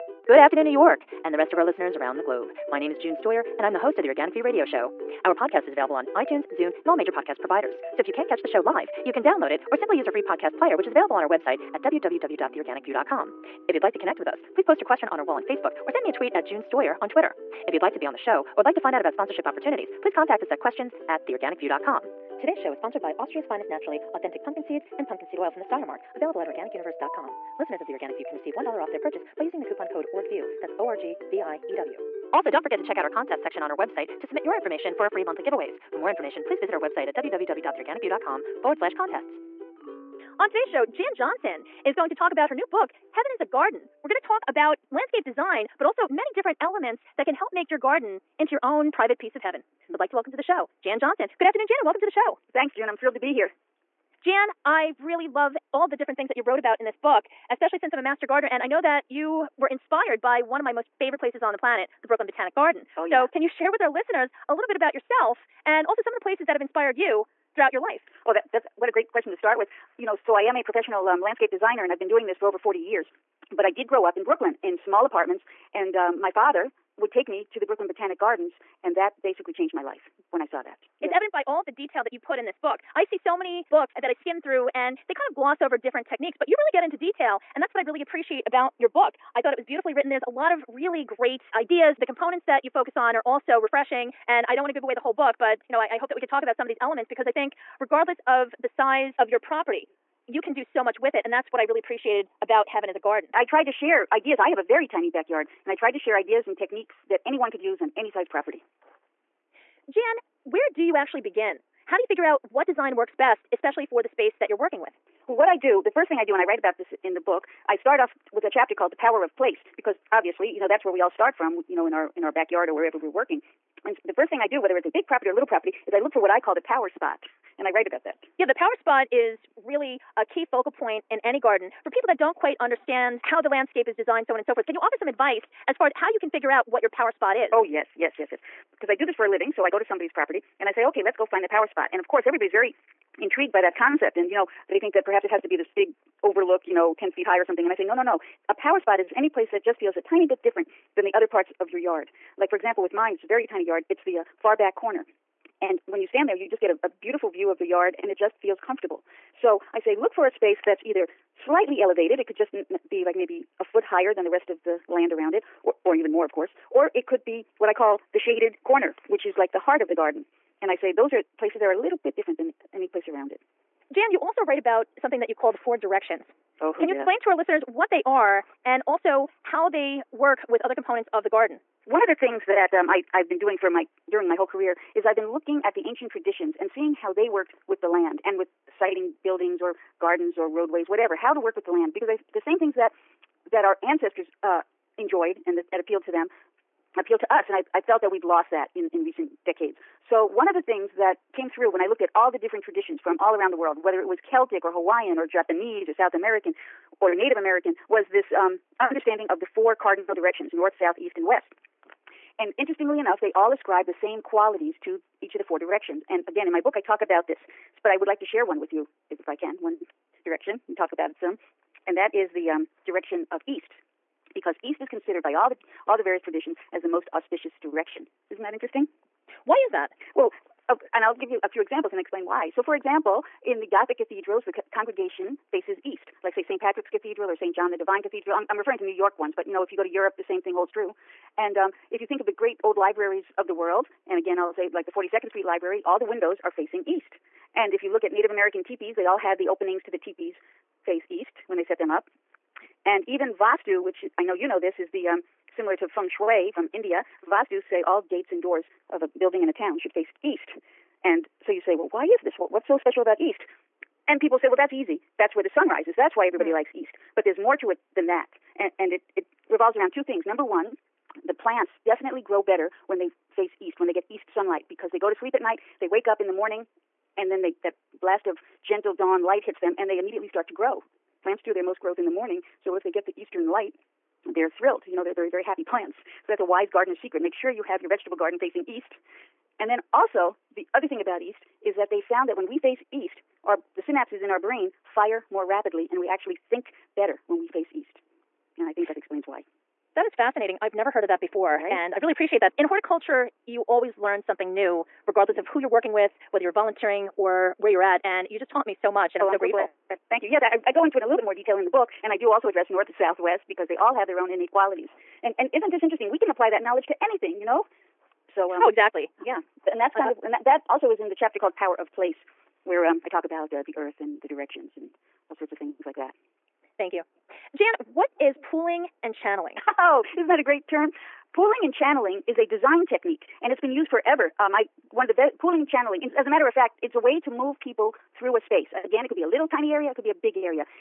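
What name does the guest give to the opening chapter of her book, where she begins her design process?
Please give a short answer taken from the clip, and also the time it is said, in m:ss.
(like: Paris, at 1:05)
The Power of Place, at 1:58.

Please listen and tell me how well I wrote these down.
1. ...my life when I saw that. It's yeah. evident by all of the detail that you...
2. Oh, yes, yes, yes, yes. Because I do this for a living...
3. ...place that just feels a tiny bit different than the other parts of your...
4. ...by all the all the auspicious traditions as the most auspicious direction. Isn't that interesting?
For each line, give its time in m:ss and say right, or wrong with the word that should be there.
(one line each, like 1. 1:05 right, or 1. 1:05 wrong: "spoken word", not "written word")
1. 1:19 right
2. 2:17 right
3. 2:29 right
4. 3:45 wrong: "various", not "auspicious".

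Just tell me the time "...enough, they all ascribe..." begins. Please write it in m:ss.
3:32.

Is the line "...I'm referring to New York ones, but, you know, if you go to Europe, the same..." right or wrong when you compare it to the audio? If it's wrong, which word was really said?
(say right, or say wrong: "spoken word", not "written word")
right.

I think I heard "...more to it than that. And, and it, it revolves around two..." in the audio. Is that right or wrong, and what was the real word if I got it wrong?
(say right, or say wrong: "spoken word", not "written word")
right.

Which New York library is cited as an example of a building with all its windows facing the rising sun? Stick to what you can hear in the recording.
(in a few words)
42nd Street Library.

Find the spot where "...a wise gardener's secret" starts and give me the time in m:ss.
4:46.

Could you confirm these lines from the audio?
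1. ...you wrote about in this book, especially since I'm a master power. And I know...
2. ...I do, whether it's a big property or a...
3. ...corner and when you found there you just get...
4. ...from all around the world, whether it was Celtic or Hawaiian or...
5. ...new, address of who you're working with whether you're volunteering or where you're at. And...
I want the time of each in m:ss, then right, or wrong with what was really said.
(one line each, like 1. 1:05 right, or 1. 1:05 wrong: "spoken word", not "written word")
1. 0:56 wrong: "gardener", not "power"
2. 2:04 right
3. 2:34 wrong: "stand", not "found"
4. 3:23 right
5. 5:04 wrong: "regardless", not "address".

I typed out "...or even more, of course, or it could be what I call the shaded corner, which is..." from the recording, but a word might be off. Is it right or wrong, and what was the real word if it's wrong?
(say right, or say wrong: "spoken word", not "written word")
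right.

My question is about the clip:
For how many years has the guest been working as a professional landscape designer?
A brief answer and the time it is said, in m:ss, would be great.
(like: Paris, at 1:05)
40, at 1:12.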